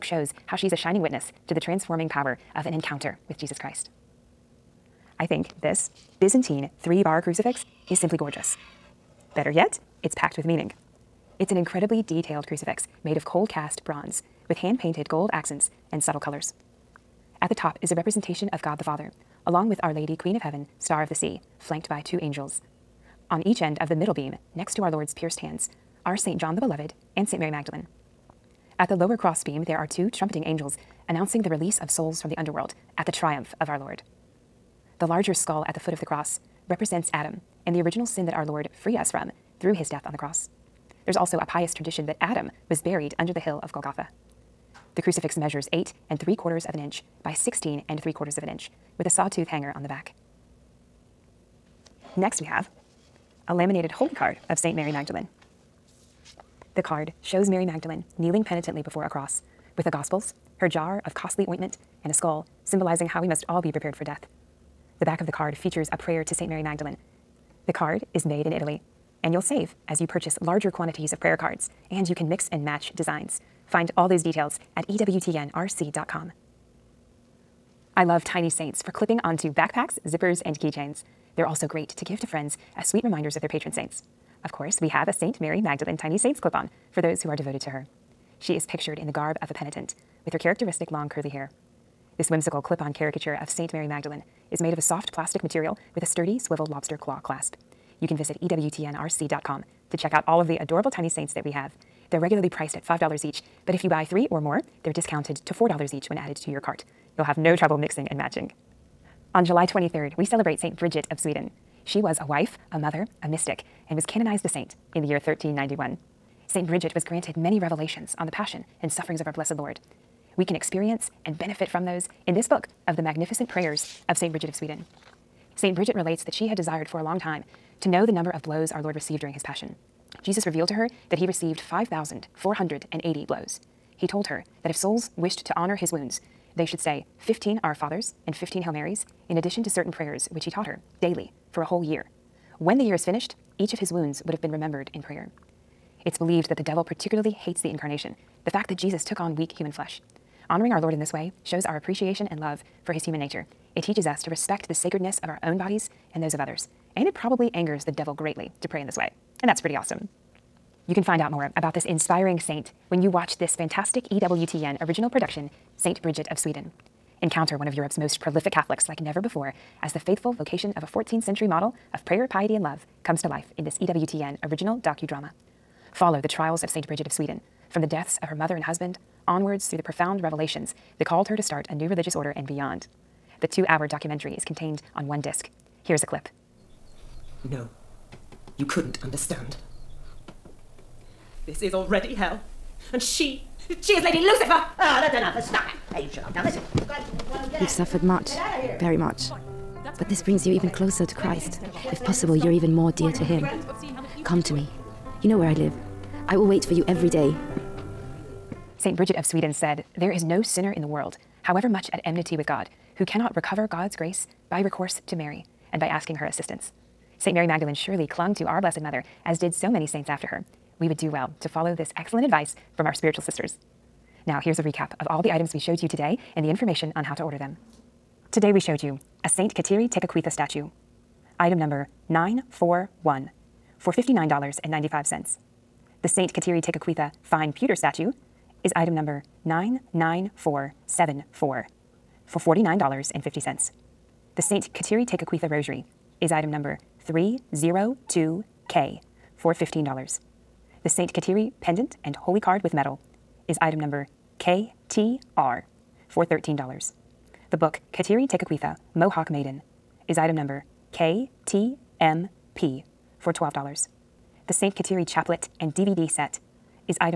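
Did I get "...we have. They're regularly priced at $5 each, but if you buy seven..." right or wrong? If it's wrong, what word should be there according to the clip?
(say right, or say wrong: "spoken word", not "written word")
wrong: "three", not "seven".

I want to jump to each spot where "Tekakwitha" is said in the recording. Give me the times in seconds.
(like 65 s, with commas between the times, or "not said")
229 s, 236 s, 245 s, 258 s.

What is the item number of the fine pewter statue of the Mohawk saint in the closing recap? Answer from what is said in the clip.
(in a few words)
99474.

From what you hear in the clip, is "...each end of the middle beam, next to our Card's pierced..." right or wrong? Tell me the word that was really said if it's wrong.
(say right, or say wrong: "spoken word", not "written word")
wrong: "Lord", not "Card".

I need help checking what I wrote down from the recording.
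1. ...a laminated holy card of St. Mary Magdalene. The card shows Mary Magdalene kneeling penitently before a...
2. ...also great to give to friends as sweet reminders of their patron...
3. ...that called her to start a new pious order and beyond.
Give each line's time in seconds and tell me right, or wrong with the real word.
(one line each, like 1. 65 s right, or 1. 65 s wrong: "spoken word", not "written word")
1. 53 s right
2. 81 s right
3. 180 s wrong: "religious", not "pious".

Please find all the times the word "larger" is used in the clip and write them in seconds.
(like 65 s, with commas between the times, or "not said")
35 s, 70 s.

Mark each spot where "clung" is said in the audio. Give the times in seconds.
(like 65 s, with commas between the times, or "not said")
218 s.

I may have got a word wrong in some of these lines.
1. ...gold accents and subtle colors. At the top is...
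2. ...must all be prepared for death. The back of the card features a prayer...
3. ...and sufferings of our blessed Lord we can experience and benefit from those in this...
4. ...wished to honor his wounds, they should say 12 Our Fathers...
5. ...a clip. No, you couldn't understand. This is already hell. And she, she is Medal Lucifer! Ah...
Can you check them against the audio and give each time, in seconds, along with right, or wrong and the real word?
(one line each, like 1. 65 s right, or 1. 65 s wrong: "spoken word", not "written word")
1. 15 s right
2. 63 s right
3. 118 s right
4. 135 s wrong: "15", not "12"
5. 186 s wrong: "Lady", not "Medal".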